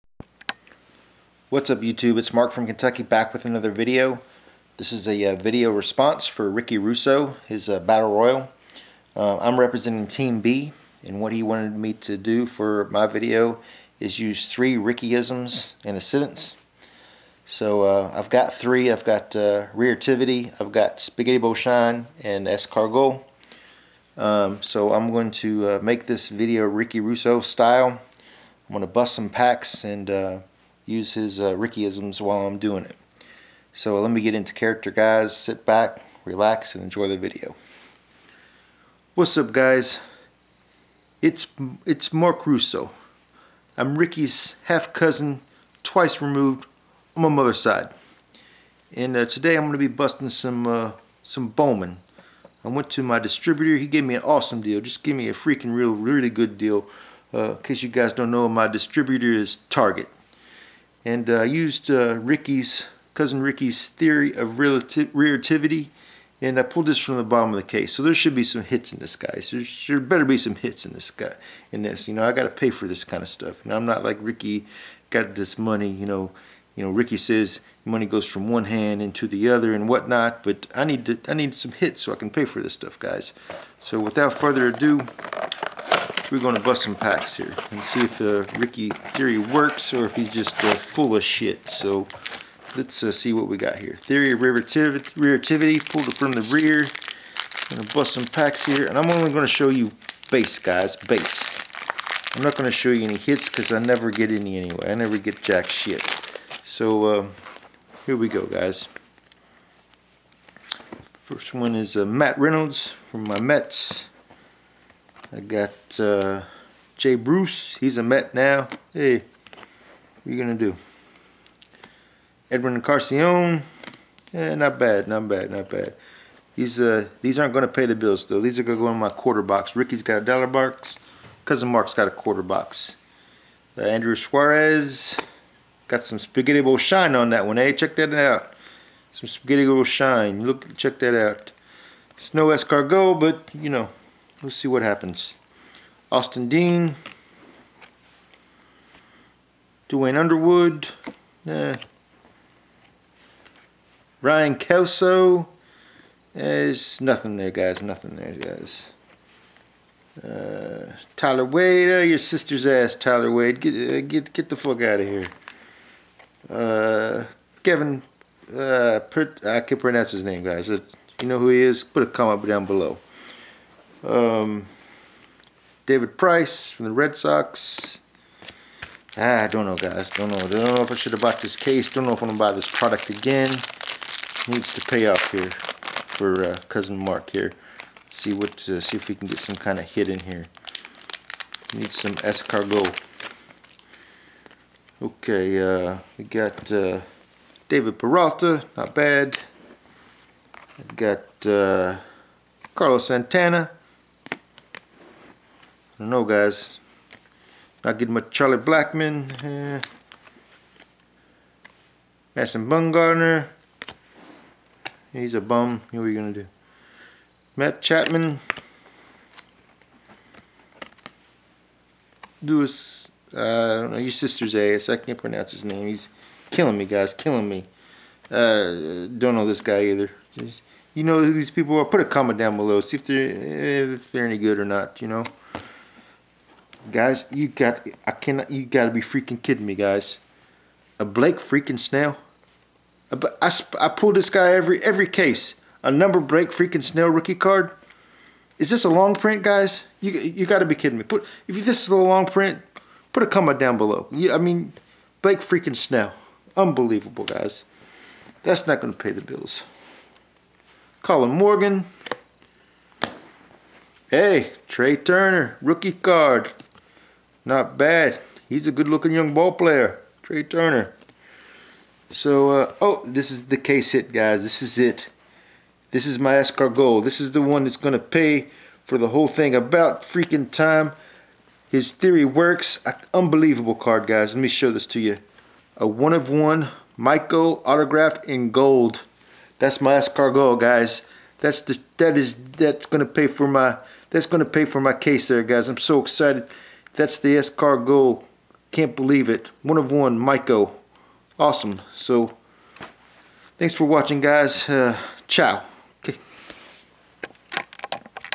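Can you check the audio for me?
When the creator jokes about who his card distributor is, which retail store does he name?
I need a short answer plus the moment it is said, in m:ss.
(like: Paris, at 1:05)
Target, at 0:59.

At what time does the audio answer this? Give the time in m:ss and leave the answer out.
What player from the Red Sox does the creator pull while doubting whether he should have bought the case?
2:55.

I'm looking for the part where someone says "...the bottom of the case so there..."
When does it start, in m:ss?
1:07.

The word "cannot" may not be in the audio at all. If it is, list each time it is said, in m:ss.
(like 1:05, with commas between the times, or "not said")
3:58.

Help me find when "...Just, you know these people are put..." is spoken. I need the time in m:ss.
3:50.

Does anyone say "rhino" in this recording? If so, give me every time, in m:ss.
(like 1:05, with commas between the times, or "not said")
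not said.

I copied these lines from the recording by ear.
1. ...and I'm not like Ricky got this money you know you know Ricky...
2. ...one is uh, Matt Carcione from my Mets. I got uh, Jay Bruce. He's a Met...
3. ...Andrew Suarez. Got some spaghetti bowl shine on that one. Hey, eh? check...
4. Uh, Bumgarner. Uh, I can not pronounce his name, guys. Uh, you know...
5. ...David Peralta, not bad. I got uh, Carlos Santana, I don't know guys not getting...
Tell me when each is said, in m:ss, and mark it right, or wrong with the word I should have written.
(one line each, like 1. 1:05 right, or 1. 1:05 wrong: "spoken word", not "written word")
1. 1:13 right
2. 1:51 wrong: "Reynolds", not "Carcione"
3. 2:13 right
4. 2:46 wrong: "Kevin", not "Bumgarner"
5. 3:17 right.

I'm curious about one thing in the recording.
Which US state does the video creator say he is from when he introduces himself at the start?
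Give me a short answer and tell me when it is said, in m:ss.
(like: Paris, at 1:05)
Kentucky, at 0:02.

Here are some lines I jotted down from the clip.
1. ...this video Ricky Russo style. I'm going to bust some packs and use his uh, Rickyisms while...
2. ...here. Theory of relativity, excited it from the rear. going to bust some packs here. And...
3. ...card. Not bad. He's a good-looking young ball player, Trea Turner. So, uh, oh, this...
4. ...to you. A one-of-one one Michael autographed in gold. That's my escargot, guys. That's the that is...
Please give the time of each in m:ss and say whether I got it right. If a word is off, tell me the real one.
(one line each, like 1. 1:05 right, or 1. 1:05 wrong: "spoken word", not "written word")
1. 0:26 right
2. 1:33 wrong: "pulled", not "excited"
3. 4:25 right
4. 4:44 right.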